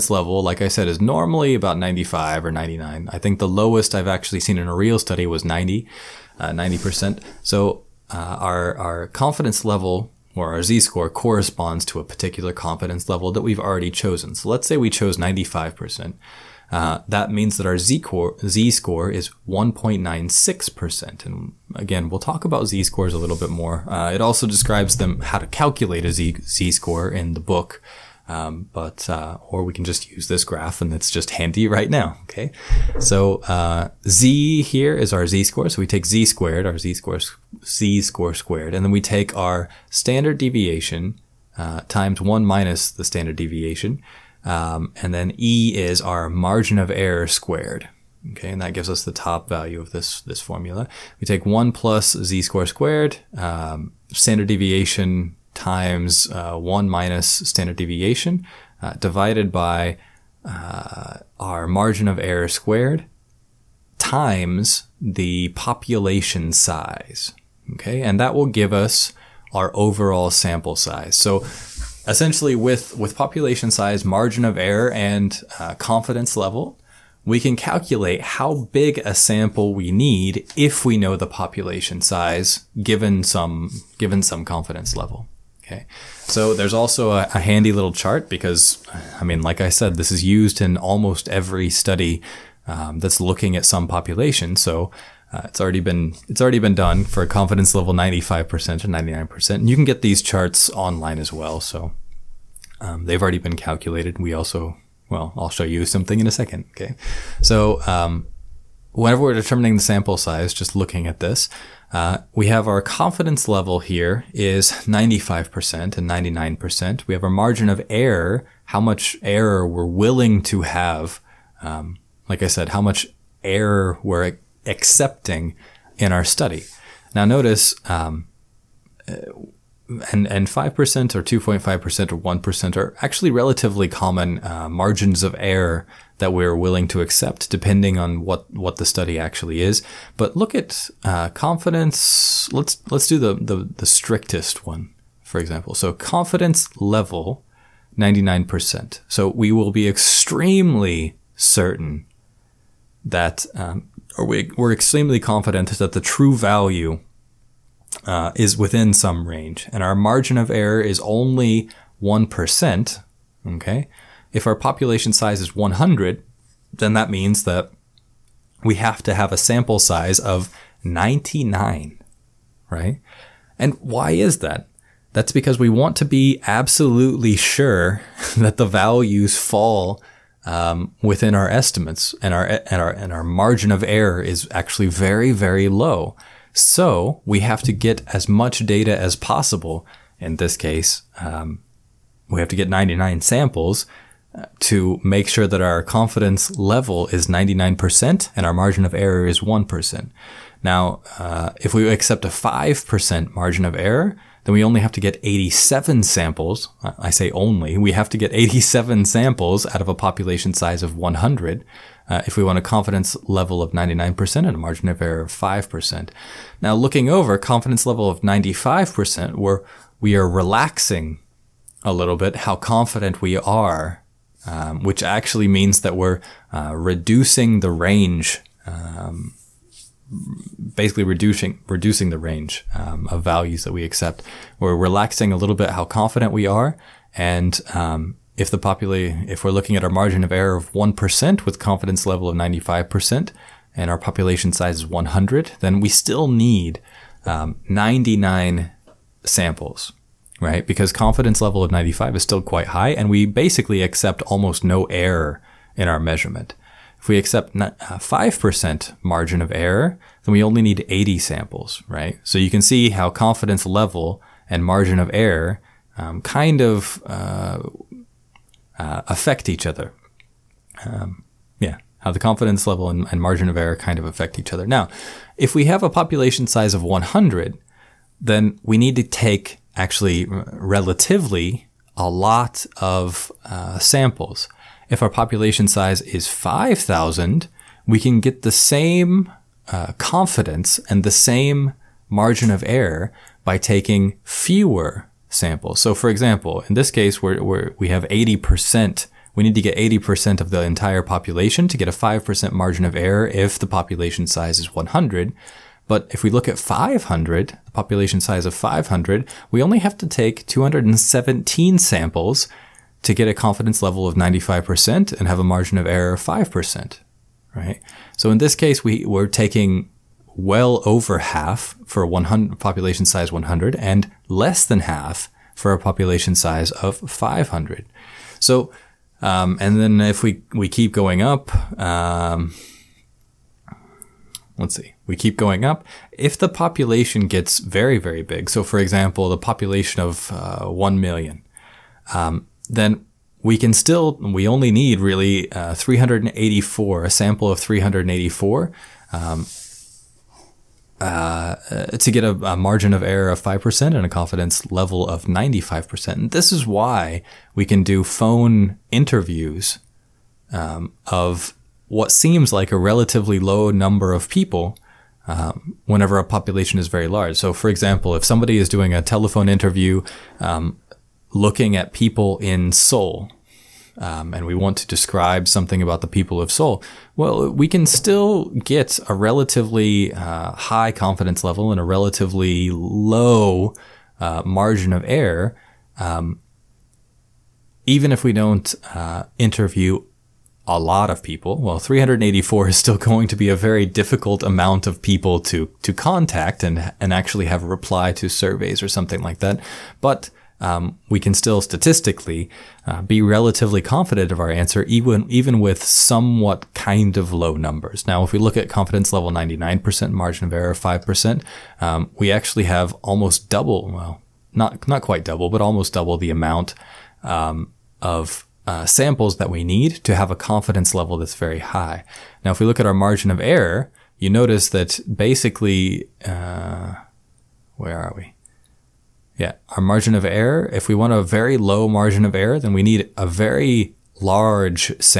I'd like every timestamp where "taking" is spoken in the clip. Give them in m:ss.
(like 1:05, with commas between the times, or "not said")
4:53, 5:19.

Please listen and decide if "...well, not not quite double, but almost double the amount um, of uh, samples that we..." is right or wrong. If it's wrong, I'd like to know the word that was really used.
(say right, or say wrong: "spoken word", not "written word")
right.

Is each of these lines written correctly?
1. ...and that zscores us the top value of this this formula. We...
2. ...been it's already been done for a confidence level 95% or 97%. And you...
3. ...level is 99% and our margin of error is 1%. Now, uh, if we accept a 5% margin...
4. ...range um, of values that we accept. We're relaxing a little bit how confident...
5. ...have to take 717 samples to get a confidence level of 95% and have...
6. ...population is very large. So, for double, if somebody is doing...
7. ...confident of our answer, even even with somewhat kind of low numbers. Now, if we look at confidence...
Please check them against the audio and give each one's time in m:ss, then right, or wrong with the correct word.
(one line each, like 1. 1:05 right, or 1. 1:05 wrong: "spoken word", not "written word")
1. 0:48 wrong: "gives", not "zscores"
2. 1:35 wrong: "99", not "97"
3. 3:16 right
4. 3:52 right
5. 5:09 wrong: "217", not "717"
6. 6:06 wrong: "example", not "double"
7. 6:43 right.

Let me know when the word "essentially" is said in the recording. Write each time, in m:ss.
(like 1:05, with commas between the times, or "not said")
1:12.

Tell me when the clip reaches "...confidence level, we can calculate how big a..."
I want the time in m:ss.
1:15.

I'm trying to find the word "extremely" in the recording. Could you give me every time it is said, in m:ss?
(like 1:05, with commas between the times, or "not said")
2:29, 2:34.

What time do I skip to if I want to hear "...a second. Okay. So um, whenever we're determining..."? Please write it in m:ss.
1:46.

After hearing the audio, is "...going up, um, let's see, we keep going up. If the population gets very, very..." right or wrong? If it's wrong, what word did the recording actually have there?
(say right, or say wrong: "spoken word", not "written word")
right.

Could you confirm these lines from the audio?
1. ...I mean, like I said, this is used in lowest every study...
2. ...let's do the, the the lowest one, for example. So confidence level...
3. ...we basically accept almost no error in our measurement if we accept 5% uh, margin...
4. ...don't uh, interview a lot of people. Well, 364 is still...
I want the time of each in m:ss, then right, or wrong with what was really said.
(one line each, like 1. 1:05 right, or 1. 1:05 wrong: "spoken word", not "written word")
1. 1:29 wrong: "almost", not "lowest"
2. 2:22 wrong: "strictest", not "lowest"
3. 4:13 right
4. 6:28 wrong: "384", not "364".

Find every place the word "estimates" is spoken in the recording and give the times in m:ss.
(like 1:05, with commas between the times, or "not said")
3:01.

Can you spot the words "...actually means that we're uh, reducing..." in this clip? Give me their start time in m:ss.
3:45.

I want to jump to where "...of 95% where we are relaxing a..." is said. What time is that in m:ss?
3:38.